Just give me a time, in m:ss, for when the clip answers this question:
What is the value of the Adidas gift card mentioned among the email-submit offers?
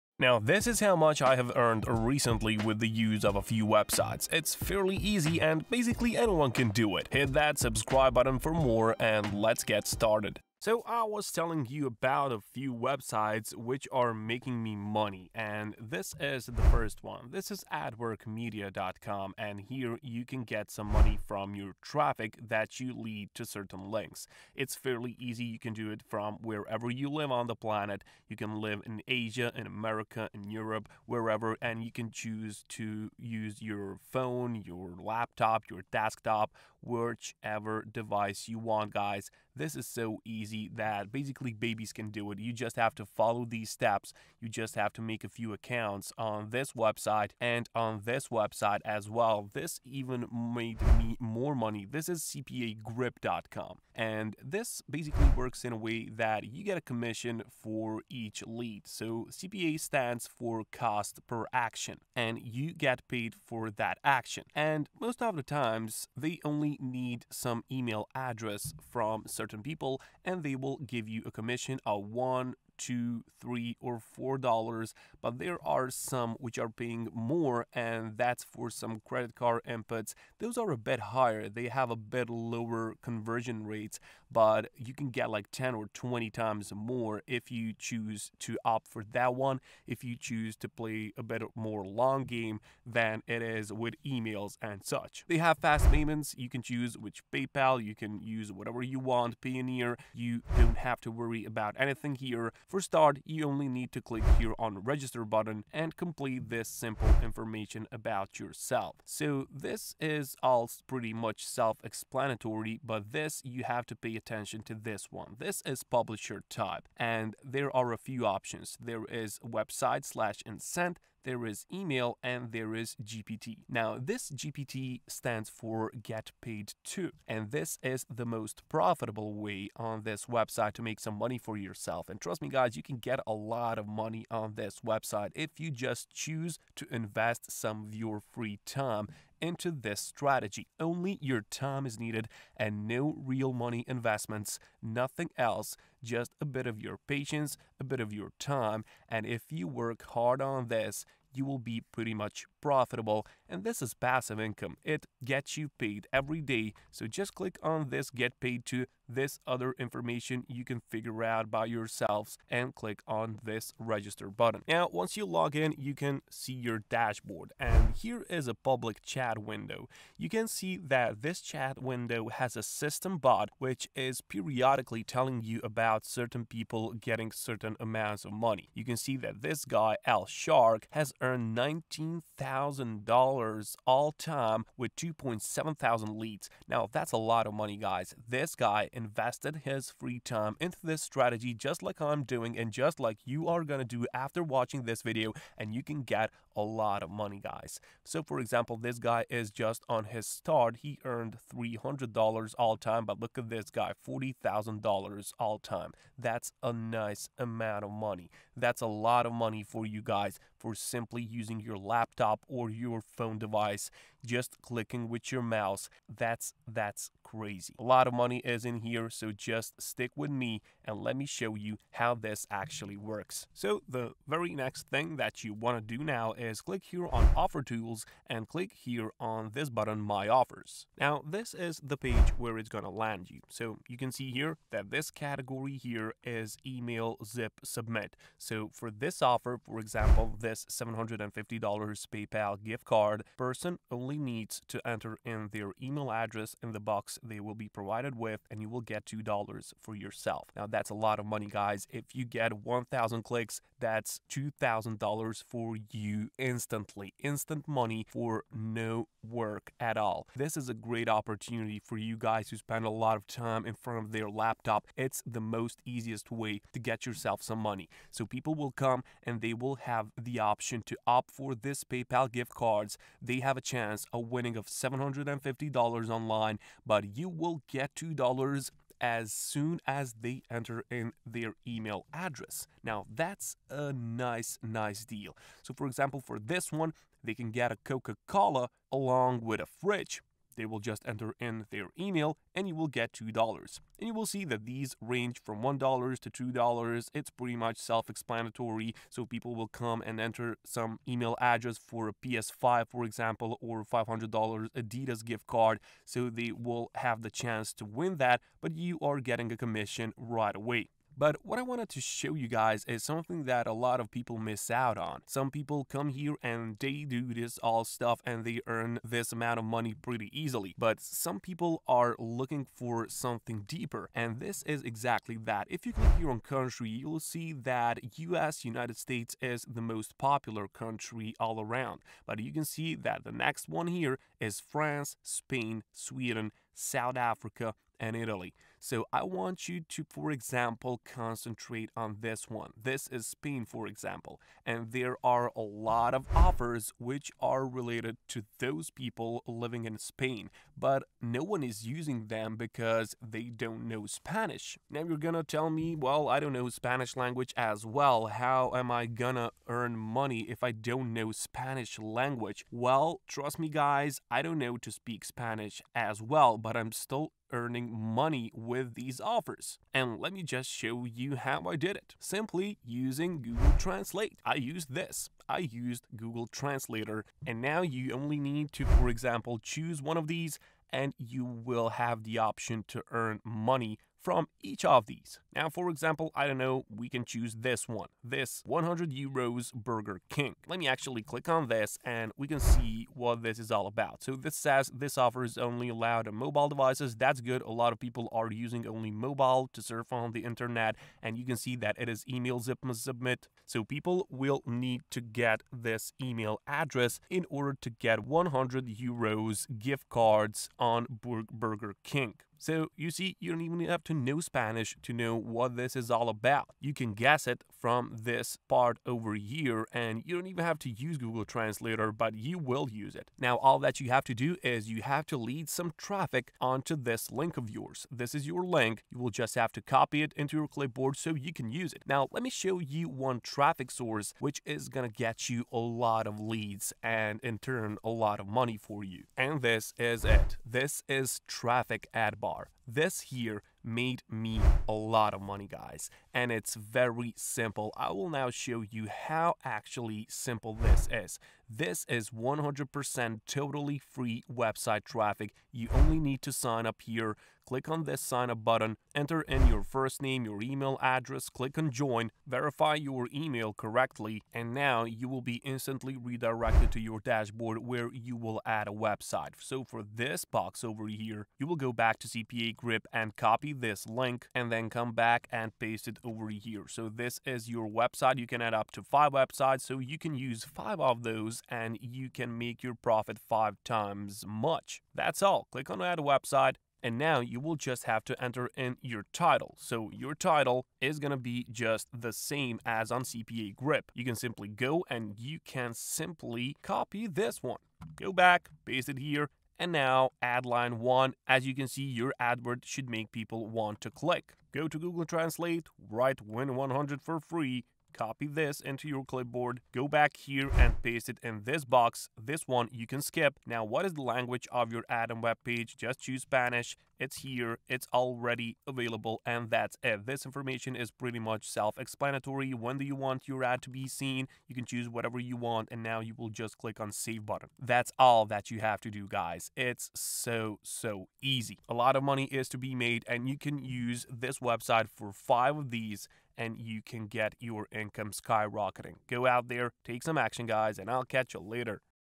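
5:03.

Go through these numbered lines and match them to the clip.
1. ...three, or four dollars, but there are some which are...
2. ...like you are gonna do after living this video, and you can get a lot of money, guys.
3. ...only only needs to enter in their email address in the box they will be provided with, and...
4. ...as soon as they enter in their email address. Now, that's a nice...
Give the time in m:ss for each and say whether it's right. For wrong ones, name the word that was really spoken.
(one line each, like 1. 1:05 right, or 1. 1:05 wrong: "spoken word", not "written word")
1. 1:13 right
2. 3:12 wrong: "watching", not "living"
3. 4:03 right
4. 4:38 right.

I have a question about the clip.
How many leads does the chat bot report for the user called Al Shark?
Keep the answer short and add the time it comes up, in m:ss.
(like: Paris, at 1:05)
2.7 thousand, at 3:04.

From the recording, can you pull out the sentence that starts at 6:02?
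Well, trust me, guys, I don't know to speak Spanish as well, but I'm still earning money with these offers.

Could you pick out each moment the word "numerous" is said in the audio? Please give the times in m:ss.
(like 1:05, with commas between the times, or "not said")
not said.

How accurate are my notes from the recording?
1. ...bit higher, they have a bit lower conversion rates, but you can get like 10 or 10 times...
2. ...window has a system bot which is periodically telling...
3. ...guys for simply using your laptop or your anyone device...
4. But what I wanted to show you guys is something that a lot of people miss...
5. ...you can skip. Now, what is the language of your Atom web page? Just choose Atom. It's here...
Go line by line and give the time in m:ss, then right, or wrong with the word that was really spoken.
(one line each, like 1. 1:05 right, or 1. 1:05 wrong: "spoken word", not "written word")
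1. 1:20 wrong: "20", not "10"
2. 2:51 right
3. 3:30 wrong: "phone", not "anyone"
4. 5:11 right
5. 8:32 wrong: "Spanish", not "Atom".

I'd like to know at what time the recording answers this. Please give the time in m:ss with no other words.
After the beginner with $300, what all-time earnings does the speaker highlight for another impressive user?
3:24.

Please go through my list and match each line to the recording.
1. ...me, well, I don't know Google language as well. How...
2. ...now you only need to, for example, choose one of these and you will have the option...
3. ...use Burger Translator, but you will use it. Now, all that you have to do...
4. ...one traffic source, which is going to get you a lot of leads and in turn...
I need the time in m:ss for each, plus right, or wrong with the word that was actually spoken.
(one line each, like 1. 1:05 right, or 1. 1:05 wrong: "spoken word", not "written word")
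1. 5:55 wrong: "Spanish", not "Google"
2. 6:17 right
3. 7:00 wrong: "Google", not "Burger"
4. 7:13 right.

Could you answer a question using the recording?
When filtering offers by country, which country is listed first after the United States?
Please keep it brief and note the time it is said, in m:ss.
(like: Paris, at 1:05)
France, at 5:34.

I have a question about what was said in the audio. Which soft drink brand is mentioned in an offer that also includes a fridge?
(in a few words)
Coca Cola.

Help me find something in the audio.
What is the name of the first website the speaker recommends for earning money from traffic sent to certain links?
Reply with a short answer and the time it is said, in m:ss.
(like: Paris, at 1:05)
adworkmedia.com, at 0:17.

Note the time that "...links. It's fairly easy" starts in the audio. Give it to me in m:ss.
0:23.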